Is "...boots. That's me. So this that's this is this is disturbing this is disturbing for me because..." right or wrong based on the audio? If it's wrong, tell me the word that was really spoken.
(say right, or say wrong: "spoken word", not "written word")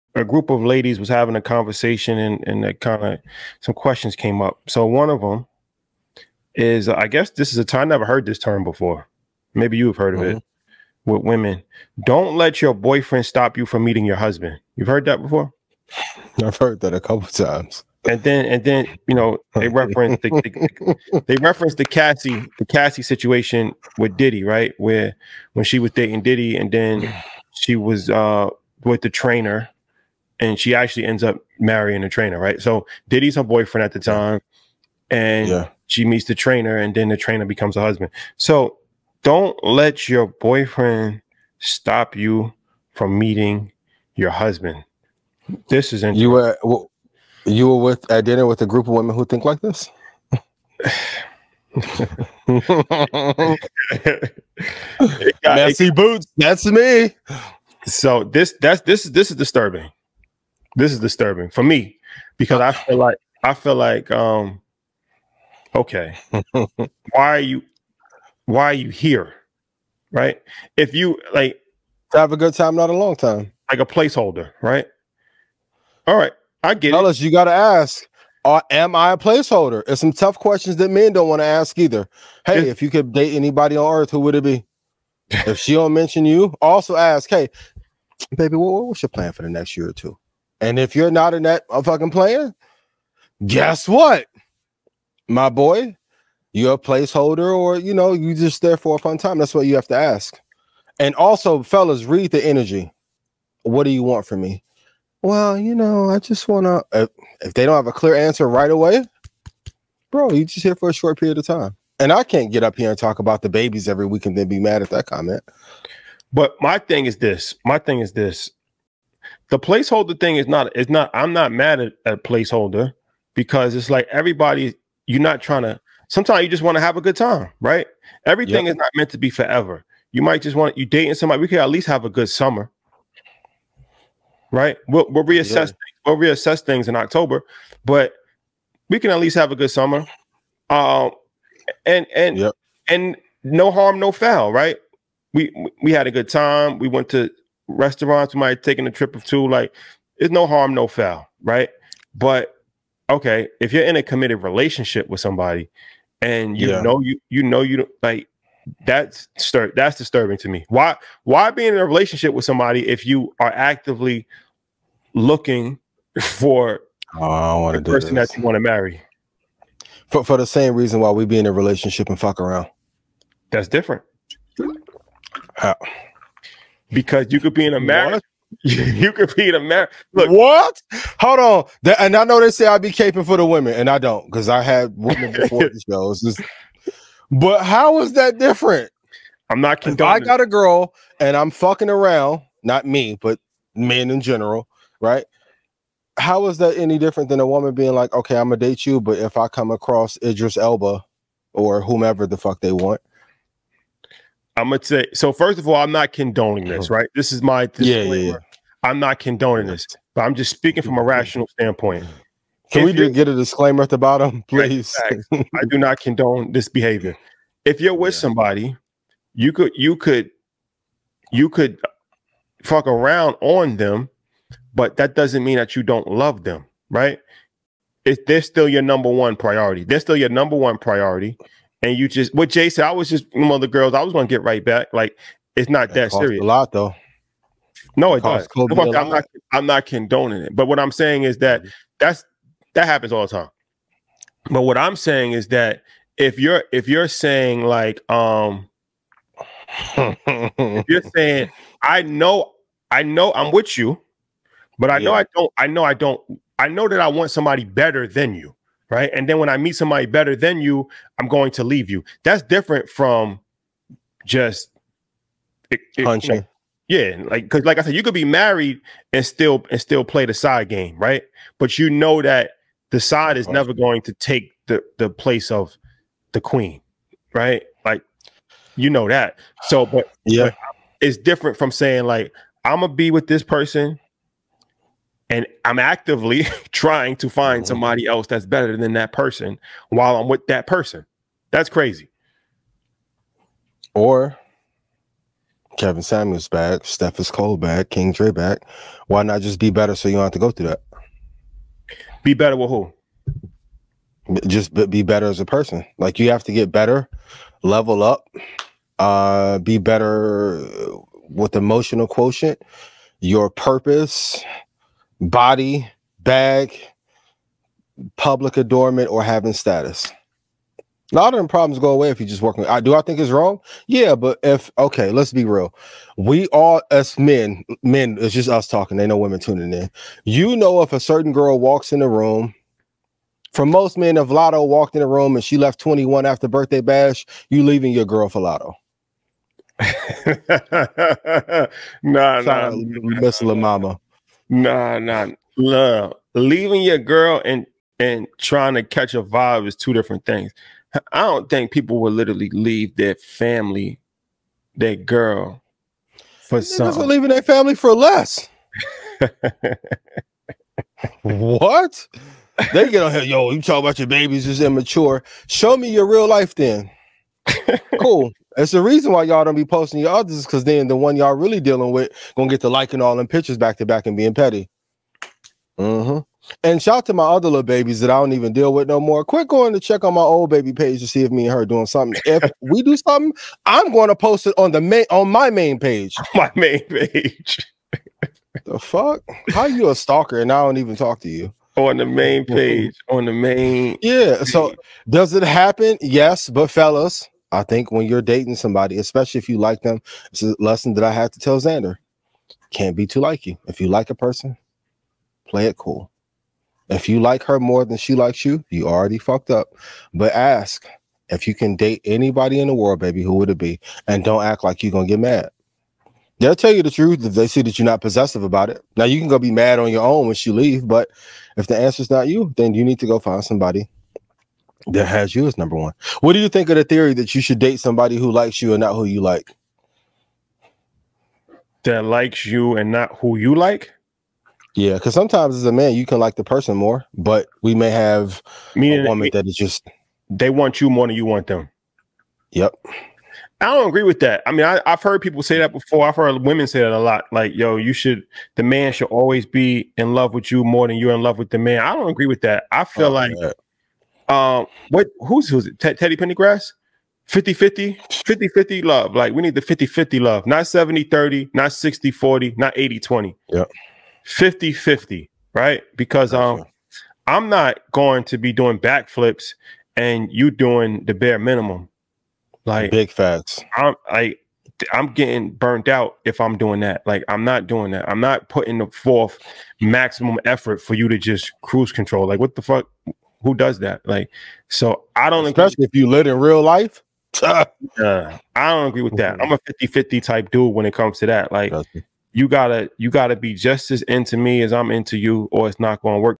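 right.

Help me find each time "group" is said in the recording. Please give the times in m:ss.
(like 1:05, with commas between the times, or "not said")
0:00, 0:48.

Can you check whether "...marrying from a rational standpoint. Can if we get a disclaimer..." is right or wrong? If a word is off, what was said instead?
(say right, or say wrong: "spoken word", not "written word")
wrong: "speaking", not "marrying".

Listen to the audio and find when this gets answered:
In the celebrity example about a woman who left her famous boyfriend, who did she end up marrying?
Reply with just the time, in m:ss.
0:31.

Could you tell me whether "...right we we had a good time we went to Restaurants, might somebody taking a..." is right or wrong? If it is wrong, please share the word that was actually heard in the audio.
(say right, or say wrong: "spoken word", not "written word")
right.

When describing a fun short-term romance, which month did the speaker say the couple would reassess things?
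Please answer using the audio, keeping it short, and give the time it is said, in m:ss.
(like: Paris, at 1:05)
October, at 2:16.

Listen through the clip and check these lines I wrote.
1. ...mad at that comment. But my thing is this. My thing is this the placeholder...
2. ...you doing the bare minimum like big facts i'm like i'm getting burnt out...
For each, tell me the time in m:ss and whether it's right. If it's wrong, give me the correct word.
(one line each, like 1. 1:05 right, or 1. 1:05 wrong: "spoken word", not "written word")
1. 1:54 right
2. 7:50 right.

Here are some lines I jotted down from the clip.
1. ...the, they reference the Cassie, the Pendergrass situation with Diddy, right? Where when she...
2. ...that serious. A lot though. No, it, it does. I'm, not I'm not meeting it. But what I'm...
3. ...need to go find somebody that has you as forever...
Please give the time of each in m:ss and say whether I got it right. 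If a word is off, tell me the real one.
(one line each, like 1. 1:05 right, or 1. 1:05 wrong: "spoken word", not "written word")
1. 0:21 wrong: "Cassie", not "Pendergrass"
2. 3:56 wrong: "condoning", not "meeting"
3. 7:02 wrong: "number", not "forever".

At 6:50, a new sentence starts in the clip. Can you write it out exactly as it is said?
But ask if you can date anybody in the world, baby, who would it be?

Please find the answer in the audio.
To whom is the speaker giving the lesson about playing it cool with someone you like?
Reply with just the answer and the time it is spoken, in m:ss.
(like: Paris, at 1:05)
Xander, at 6:41.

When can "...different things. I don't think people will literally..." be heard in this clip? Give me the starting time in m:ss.
5:49.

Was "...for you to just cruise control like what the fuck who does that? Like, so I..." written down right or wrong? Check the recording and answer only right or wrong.
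right.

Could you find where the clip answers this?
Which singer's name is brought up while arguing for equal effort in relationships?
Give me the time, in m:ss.
7:35.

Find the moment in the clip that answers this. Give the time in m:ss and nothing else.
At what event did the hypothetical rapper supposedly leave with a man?
5:36.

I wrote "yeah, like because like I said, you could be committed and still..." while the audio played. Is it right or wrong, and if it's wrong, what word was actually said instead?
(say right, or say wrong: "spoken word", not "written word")
wrong: "married", not "committed".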